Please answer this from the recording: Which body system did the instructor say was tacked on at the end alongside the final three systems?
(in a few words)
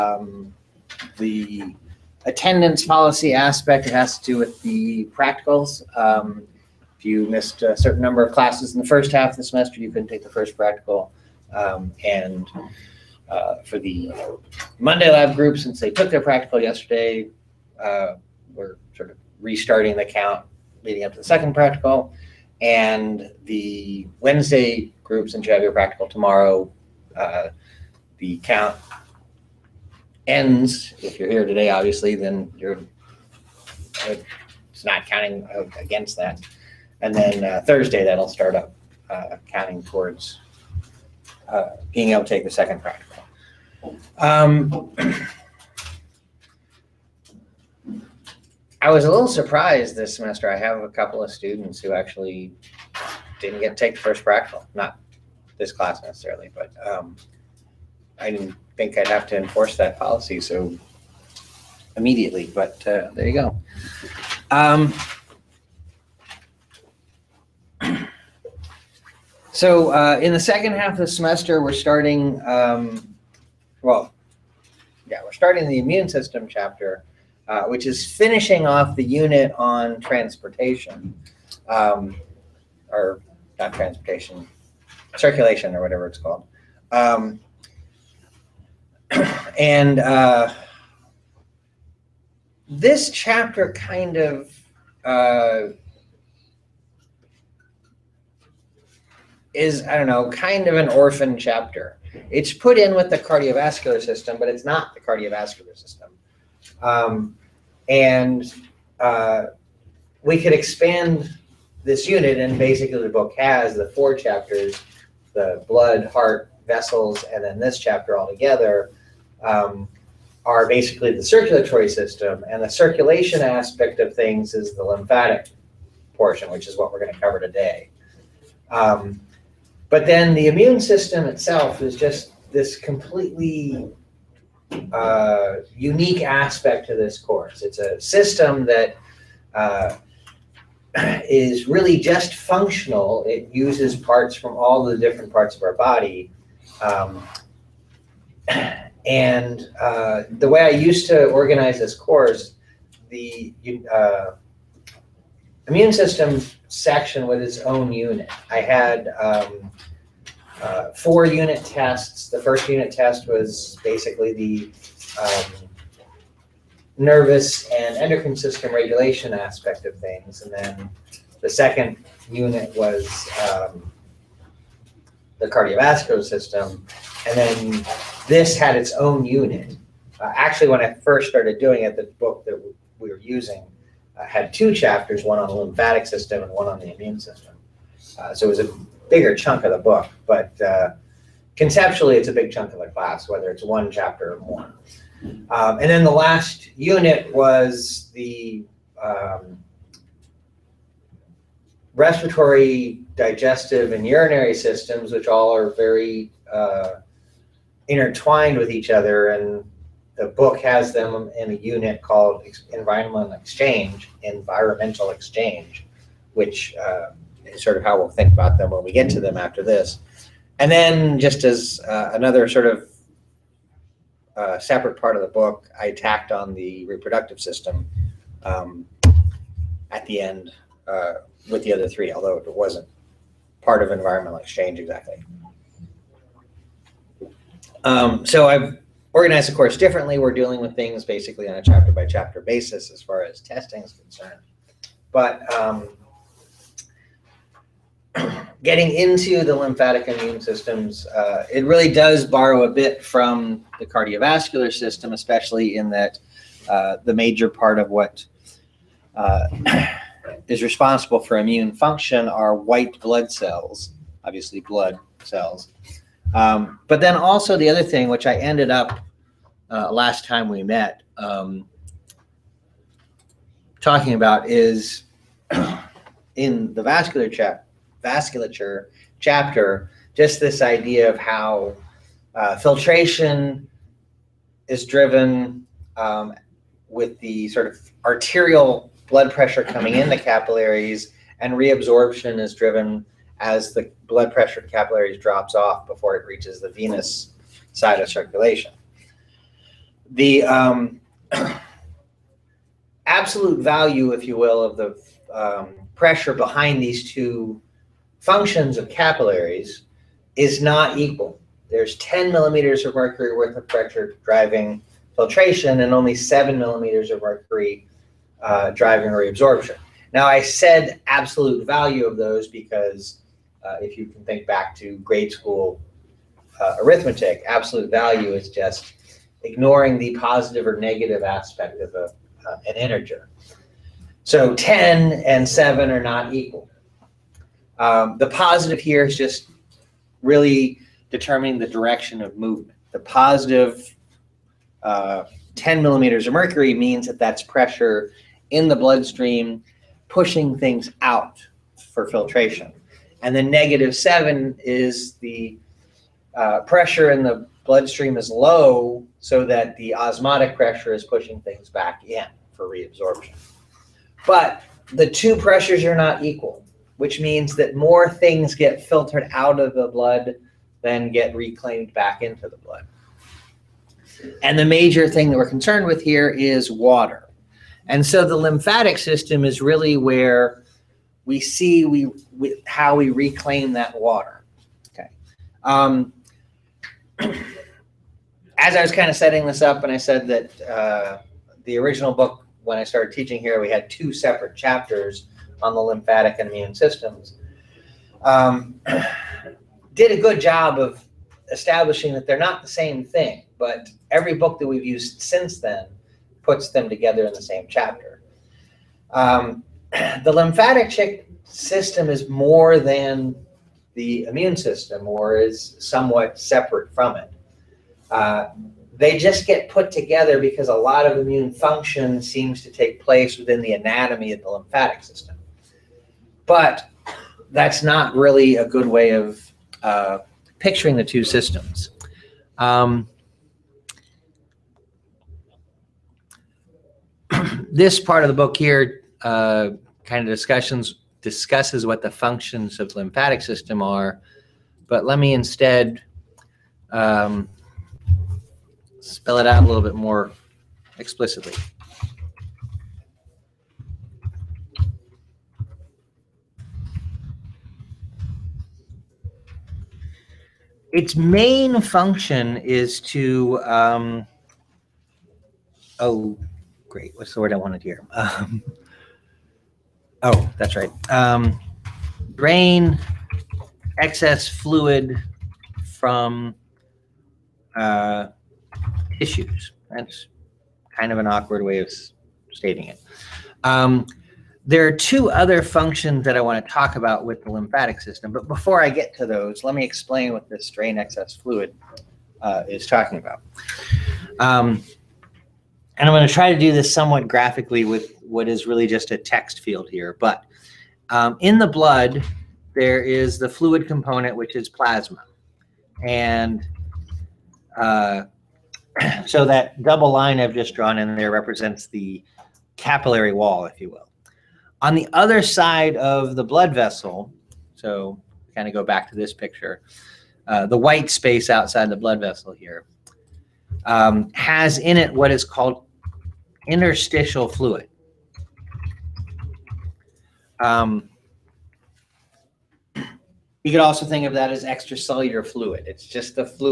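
reproductive system.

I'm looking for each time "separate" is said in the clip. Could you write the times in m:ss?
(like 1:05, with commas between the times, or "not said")
3:44, 6:34, 6:56.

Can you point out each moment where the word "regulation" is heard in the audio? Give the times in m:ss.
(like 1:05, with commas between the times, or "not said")
2:48.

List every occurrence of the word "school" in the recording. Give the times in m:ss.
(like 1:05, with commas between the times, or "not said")
5:25.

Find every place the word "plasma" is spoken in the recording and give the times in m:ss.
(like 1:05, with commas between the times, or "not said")
8:24.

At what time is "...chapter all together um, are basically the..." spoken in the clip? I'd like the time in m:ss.
1:57.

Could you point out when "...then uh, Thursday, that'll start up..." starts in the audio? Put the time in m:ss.
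0:37.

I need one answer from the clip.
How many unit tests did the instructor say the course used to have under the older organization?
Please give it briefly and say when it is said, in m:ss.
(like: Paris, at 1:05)
4, at 2:40.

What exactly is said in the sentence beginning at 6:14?
And the major thing that we're concerned with here is water.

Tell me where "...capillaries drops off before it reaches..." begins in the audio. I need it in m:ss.
4:54.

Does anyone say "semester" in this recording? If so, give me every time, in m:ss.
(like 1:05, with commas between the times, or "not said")
0:09, 0:50, 1:11.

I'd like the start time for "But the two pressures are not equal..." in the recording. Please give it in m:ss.
6:04.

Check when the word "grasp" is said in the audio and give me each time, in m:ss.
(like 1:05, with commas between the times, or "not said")
not said.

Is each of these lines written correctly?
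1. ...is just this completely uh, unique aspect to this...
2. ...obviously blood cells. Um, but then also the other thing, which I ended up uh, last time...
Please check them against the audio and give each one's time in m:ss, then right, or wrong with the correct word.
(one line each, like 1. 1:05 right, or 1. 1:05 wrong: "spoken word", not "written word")
1. 2:11 right
2. 4:24 right.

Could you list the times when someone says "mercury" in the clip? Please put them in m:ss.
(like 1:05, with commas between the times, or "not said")
5:12, 5:17, 5:46.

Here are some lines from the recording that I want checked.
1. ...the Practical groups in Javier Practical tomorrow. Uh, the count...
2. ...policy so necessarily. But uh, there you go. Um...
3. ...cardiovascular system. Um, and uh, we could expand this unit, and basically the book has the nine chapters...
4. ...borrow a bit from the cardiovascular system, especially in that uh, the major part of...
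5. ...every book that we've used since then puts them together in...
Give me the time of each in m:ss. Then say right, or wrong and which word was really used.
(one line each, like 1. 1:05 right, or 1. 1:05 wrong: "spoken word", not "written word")
1. 0:23 wrong: "Wednesday", not "Practical"
2. 0:59 wrong: "immediately", not "necessarily"
3. 1:45 wrong: "four", not "nine"
4. 4:12 right
5. 6:44 right.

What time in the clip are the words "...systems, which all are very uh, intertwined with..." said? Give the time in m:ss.
3:24.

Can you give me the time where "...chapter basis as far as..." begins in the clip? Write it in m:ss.
4:02.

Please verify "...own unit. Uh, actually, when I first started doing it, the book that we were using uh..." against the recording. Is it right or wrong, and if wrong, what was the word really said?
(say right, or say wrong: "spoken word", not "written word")
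right.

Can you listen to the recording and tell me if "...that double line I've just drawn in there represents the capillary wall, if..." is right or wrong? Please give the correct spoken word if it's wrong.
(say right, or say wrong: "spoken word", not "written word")
right.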